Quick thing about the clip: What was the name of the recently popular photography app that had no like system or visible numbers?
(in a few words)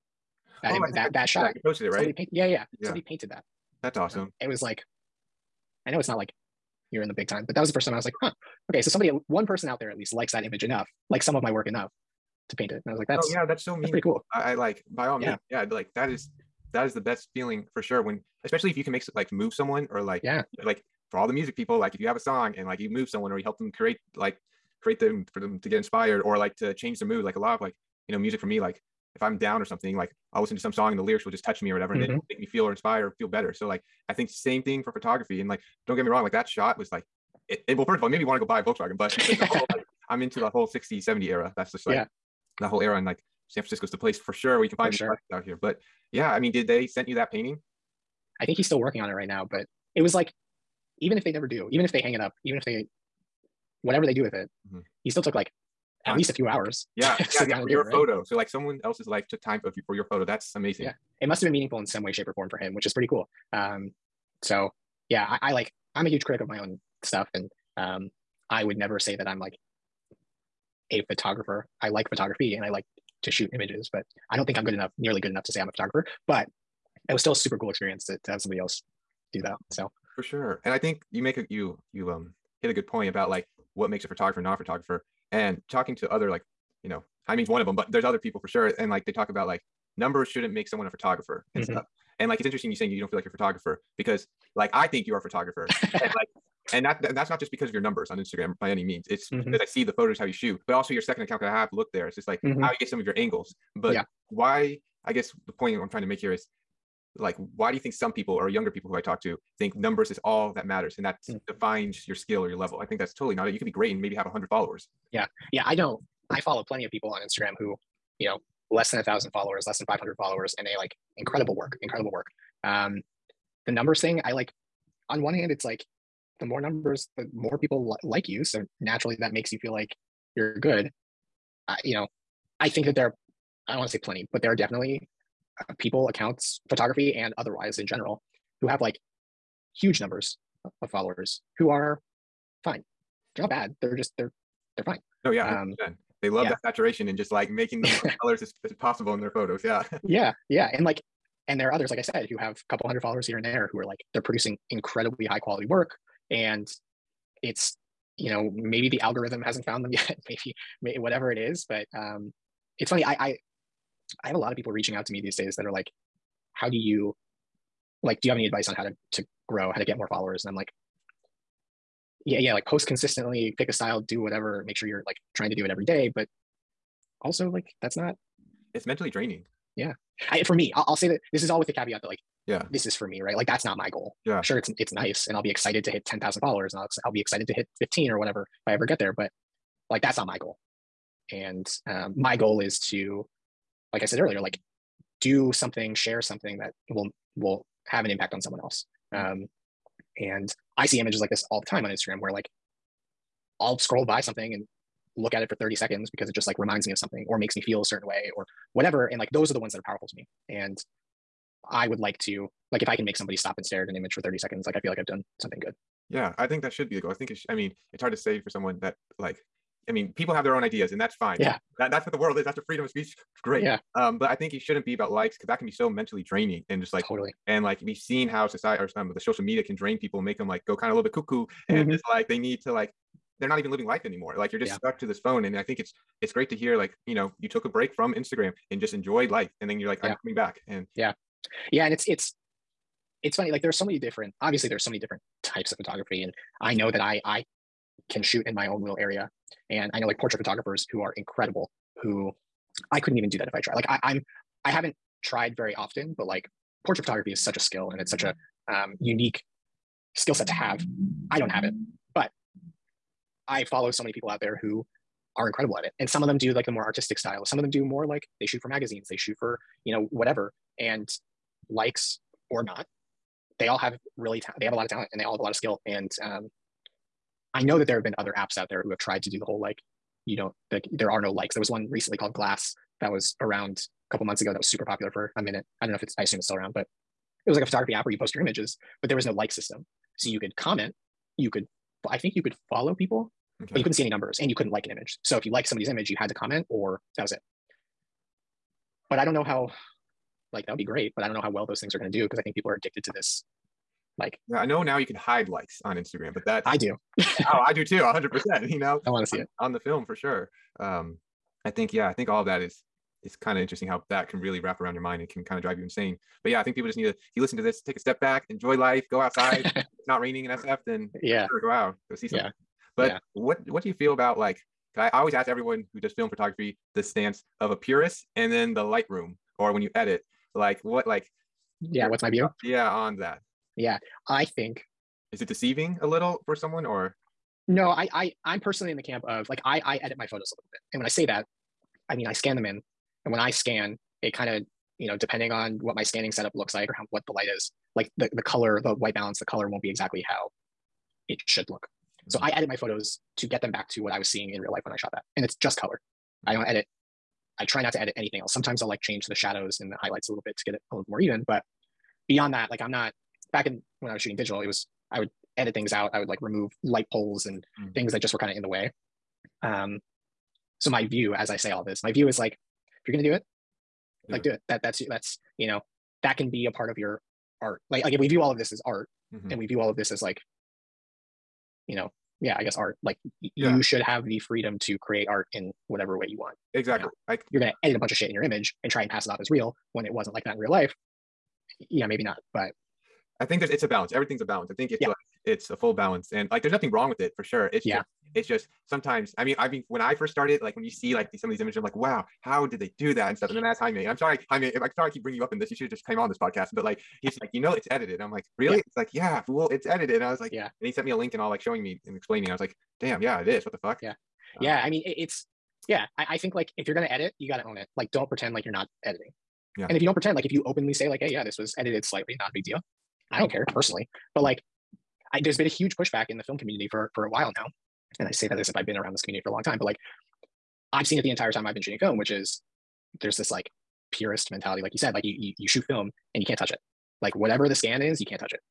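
Glass.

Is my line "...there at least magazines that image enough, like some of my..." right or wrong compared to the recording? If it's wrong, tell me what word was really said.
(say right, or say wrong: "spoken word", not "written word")
wrong: "likes", not "magazines".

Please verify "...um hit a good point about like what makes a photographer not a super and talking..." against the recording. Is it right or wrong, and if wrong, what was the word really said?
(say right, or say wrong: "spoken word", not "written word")
wrong: "photographer", not "super".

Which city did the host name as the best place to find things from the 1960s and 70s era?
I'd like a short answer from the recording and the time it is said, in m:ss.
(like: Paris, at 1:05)
San Francisco, at 0:43.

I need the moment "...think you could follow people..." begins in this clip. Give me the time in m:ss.
4:52.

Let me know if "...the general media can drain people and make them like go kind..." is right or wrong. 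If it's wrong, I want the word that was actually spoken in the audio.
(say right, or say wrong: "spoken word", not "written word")
wrong: "social", not "general".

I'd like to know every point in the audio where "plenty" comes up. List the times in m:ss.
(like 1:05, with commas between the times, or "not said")
1:56, 2:13.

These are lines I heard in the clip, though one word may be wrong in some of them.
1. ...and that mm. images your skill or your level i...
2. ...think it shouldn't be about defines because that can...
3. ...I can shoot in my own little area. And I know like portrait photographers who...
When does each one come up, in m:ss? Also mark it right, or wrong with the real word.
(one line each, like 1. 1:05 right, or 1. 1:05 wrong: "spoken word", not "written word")
1. 1:50 wrong: "defines", not "images"
2. 3:44 wrong: "likes", not "defines"
3. 4:07 right.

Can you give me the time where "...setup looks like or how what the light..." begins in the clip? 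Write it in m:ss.
5:46.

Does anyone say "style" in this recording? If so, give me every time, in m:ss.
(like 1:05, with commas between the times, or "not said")
2:53, 4:27.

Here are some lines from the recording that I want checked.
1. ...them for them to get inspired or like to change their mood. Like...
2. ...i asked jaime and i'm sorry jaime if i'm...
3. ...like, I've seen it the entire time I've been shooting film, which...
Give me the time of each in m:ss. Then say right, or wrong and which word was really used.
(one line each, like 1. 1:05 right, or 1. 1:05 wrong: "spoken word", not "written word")
1. 0:24 right
2. 6:43 right
3. 7:09 right.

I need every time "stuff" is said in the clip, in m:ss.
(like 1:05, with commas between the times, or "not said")
1:07, 1:31, 6:43.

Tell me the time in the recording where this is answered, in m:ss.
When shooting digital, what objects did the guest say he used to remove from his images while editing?
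6:06.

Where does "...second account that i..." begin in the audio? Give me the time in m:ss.
1:40.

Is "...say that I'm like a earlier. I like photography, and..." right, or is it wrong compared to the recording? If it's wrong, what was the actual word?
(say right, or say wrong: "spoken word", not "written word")
wrong: "photographer", not "earlier".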